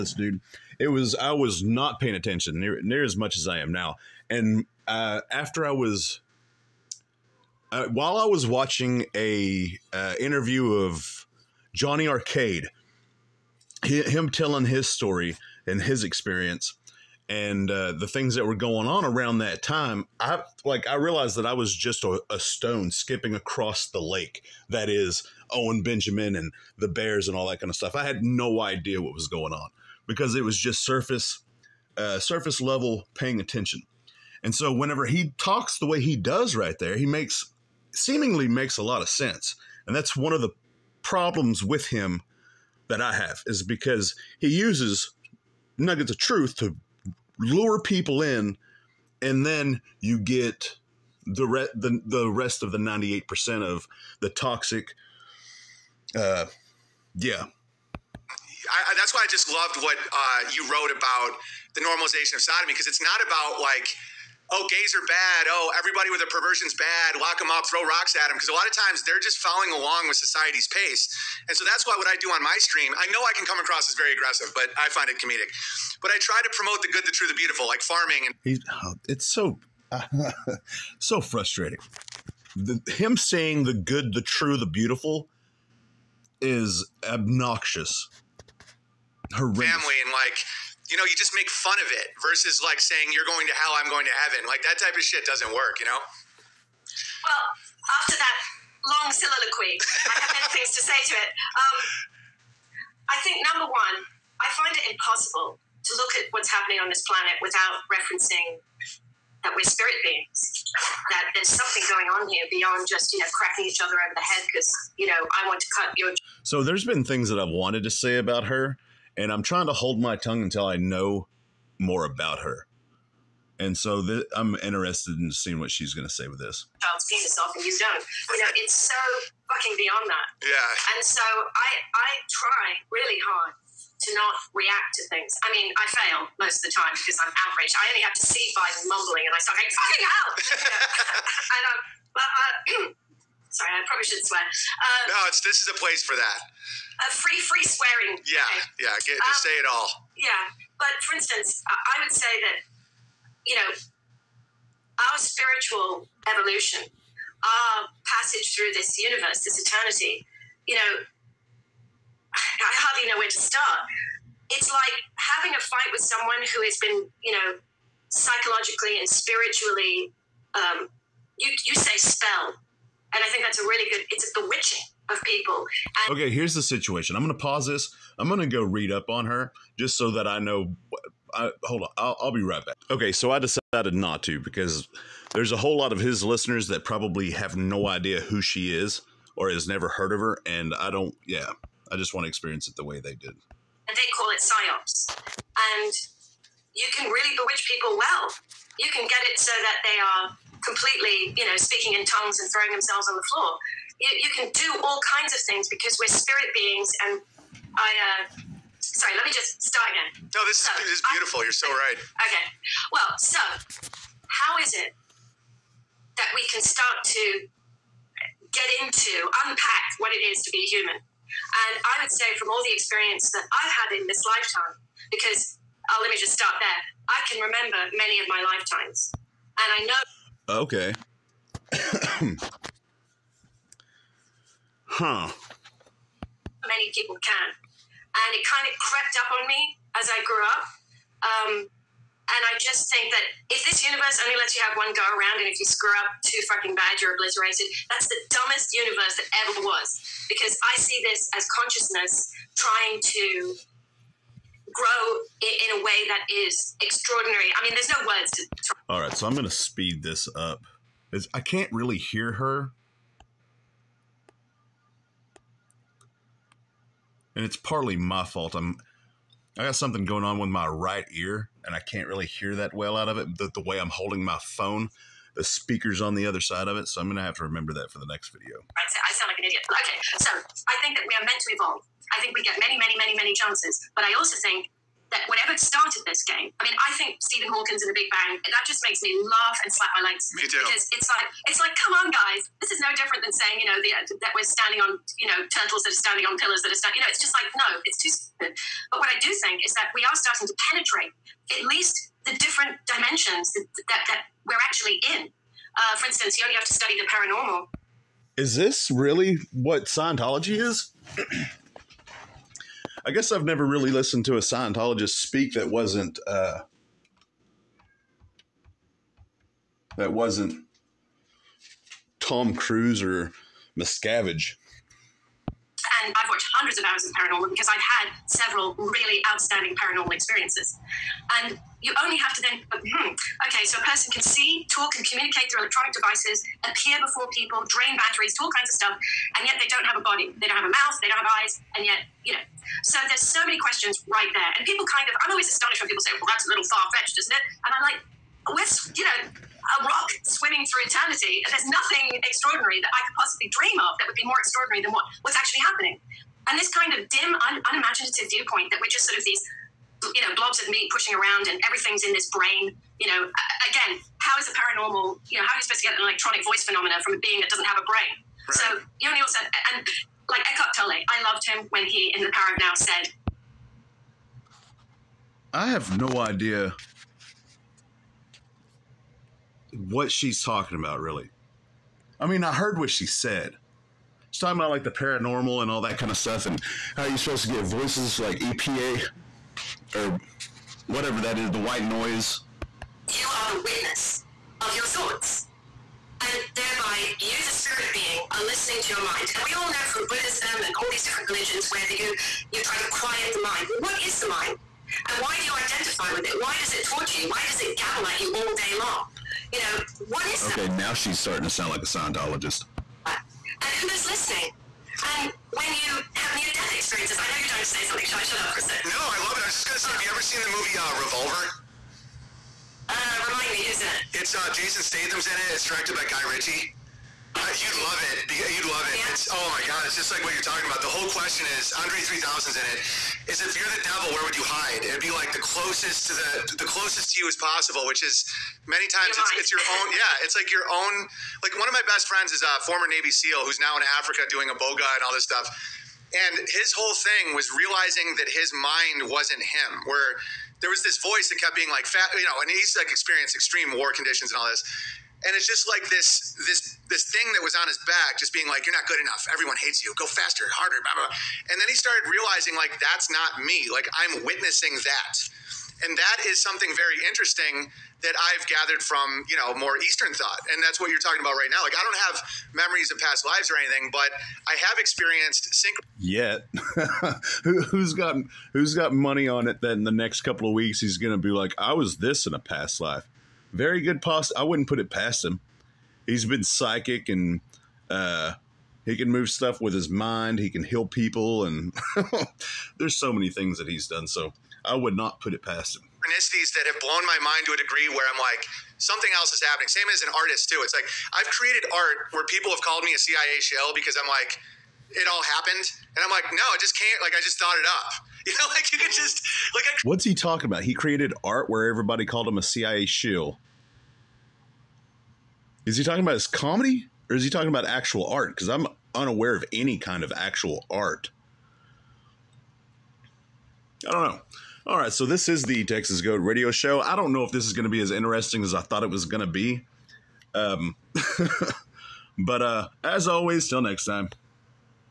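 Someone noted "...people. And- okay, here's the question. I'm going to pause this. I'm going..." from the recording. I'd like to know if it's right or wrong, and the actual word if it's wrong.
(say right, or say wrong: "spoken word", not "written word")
wrong: "situation", not "question".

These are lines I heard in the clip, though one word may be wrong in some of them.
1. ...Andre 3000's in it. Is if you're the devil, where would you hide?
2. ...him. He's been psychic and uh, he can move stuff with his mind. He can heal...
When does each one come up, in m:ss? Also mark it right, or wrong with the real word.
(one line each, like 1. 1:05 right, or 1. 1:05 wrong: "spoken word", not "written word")
1. 7:11 right
2. 8:05 right.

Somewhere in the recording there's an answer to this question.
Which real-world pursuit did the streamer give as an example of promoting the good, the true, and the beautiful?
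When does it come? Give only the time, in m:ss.
1:17.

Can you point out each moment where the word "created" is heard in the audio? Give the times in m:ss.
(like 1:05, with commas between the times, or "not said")
8:21, 8:30.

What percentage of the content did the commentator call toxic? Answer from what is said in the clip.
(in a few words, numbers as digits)
98.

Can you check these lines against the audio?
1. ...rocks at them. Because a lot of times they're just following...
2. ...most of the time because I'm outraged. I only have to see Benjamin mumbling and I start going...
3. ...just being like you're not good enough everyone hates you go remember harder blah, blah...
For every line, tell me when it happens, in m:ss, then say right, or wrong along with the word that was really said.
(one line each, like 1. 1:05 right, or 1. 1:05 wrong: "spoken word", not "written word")
1. 1:07 right
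2. 2:16 wrong: "Biden", not "Benjamin"
3. 7:38 wrong: "faster", not "remember".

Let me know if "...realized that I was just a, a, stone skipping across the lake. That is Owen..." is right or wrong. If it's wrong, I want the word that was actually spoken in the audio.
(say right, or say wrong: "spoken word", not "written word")
right.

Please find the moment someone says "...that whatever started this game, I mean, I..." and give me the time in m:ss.
4:45.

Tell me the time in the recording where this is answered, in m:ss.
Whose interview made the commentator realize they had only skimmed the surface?
0:11.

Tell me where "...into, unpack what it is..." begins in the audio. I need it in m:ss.
3:38.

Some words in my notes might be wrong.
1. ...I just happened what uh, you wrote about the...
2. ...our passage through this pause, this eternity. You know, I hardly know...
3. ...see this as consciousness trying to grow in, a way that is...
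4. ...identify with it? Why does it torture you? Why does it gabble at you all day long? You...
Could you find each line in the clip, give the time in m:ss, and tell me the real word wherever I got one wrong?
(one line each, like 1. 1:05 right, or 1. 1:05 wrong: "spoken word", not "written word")
1. 0:59 wrong: "loved", not "happened"
2. 2:36 wrong: "universe", not "pause"
3. 4:10 right
4. 6:45 right.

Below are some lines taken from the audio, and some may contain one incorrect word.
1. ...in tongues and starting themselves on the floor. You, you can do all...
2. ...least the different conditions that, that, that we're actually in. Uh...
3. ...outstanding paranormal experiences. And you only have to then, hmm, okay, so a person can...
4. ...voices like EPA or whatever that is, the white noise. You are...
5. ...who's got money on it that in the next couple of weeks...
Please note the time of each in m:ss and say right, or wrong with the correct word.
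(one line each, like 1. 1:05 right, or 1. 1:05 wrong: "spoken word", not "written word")
1. 3:21 wrong: "throwing", not "starting"
2. 5:01 wrong: "dimensions", not "conditions"
3. 5:29 right
4. 6:27 right
5. 7:58 right.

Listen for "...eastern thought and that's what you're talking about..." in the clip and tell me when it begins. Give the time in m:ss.
7:49.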